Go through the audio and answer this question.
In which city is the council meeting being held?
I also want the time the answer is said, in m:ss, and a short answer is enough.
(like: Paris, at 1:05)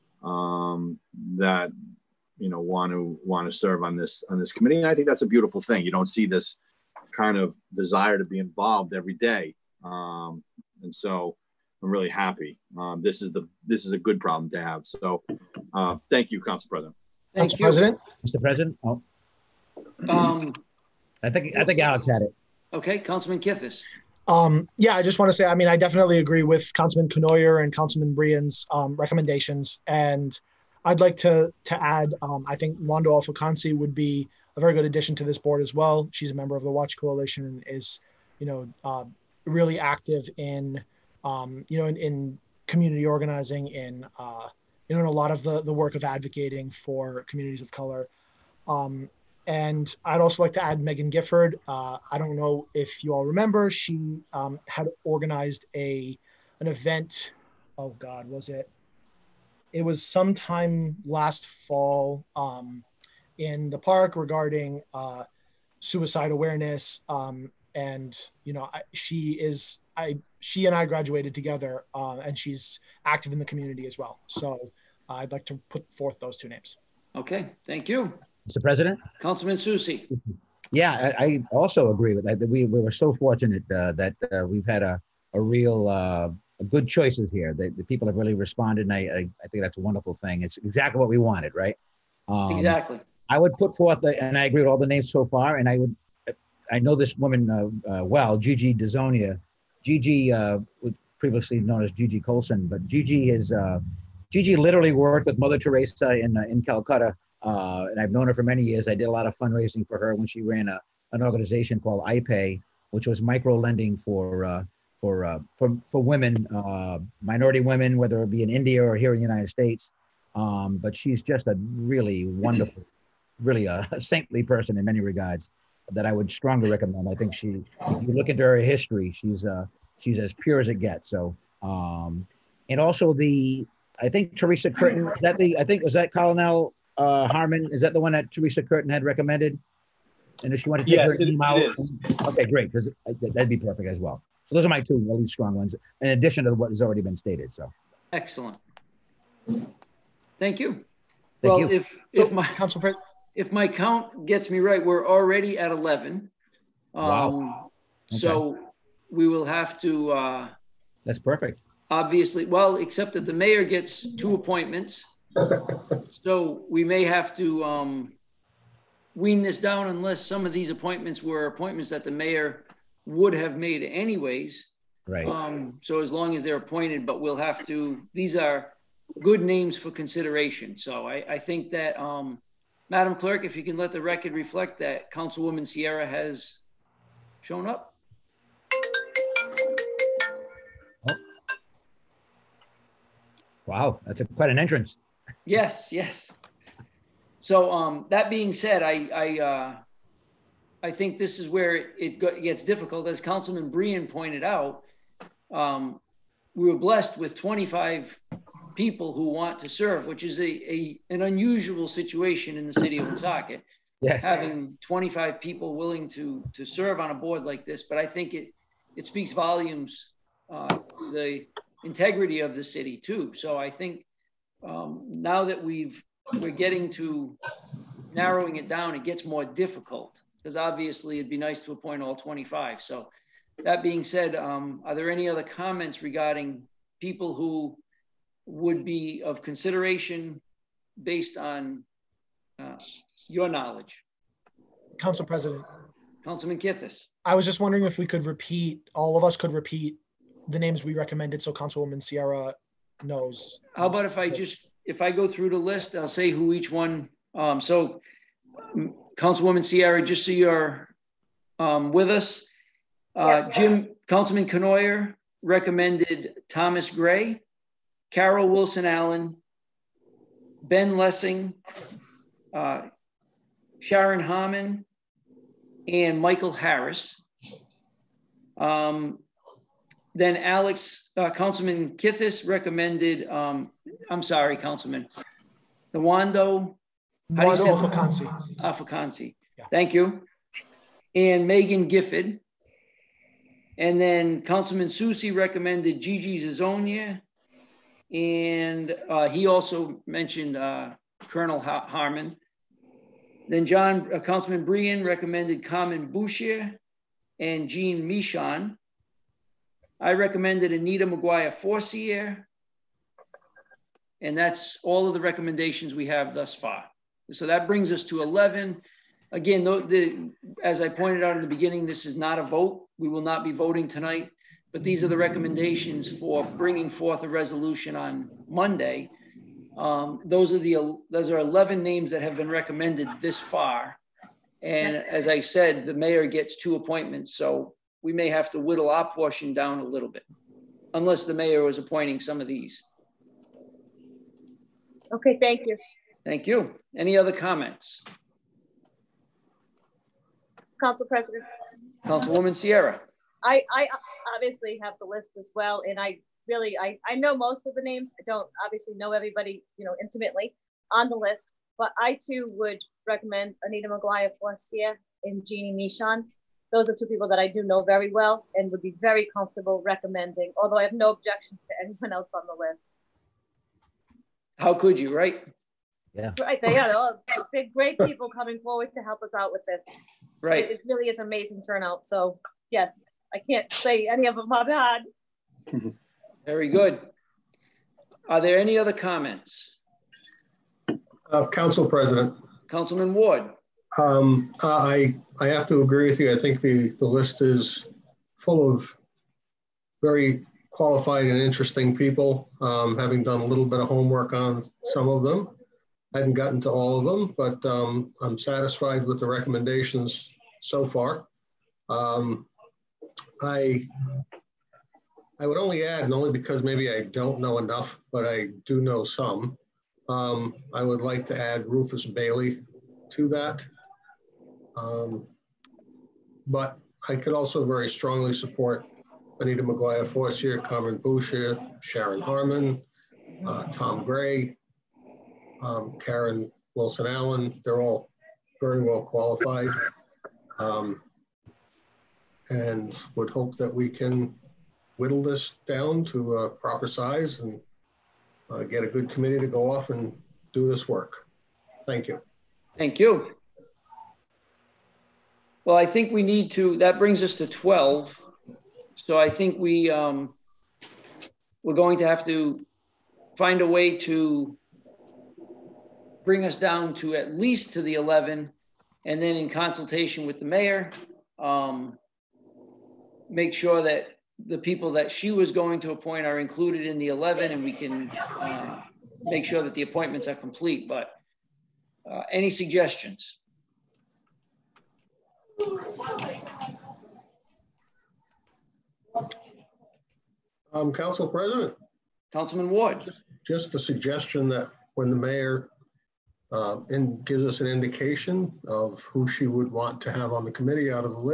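Woonsocket, at 3:33.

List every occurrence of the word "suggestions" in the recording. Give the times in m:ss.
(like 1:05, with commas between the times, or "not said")
8:02, 8:13.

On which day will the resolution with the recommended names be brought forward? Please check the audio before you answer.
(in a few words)
Monday.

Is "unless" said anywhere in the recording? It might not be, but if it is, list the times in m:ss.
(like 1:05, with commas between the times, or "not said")
2:49, 5:40.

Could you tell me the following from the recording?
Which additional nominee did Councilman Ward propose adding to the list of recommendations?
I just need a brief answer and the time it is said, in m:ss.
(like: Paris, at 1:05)
Rufus Bailey, at 7:01.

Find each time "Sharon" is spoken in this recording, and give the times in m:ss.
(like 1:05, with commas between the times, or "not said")
4:33, 7:11.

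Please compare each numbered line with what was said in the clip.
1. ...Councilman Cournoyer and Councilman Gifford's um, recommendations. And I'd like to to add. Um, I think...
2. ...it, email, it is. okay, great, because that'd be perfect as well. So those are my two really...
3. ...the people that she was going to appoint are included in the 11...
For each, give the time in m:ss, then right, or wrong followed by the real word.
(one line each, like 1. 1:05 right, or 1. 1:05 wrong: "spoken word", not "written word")
1. 0:26 wrong: "Brien", not "Gifford"
2. 2:21 right
3. 7:54 right.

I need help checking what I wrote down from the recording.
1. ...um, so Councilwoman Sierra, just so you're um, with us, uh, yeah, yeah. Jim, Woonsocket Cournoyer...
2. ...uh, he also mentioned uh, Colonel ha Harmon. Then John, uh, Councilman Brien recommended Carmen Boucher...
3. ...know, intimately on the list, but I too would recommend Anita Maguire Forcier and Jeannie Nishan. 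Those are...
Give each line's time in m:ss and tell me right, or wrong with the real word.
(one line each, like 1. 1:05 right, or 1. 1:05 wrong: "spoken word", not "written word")
1. 4:17 wrong: "Councilman", not "Woonsocket"
2. 4:59 right
3. 5:59 right.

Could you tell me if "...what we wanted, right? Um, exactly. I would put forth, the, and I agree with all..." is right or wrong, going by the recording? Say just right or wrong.
right.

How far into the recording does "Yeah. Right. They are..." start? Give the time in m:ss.
6:16.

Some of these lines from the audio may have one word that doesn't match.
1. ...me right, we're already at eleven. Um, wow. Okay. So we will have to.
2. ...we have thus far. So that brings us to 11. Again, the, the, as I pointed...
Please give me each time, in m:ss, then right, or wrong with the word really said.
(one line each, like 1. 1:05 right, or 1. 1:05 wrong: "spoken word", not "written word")
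1. 2:34 right
2. 5:15 right.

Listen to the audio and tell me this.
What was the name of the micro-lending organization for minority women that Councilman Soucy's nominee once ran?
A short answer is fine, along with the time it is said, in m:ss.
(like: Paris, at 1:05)
IPay, at 1:52.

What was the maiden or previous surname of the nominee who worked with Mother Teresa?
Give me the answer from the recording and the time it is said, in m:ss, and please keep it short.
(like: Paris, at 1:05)
Colson, at 1:42.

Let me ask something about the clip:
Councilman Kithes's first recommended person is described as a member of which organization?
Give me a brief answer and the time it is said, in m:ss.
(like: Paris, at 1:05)
Watch Coalition, at 0:36.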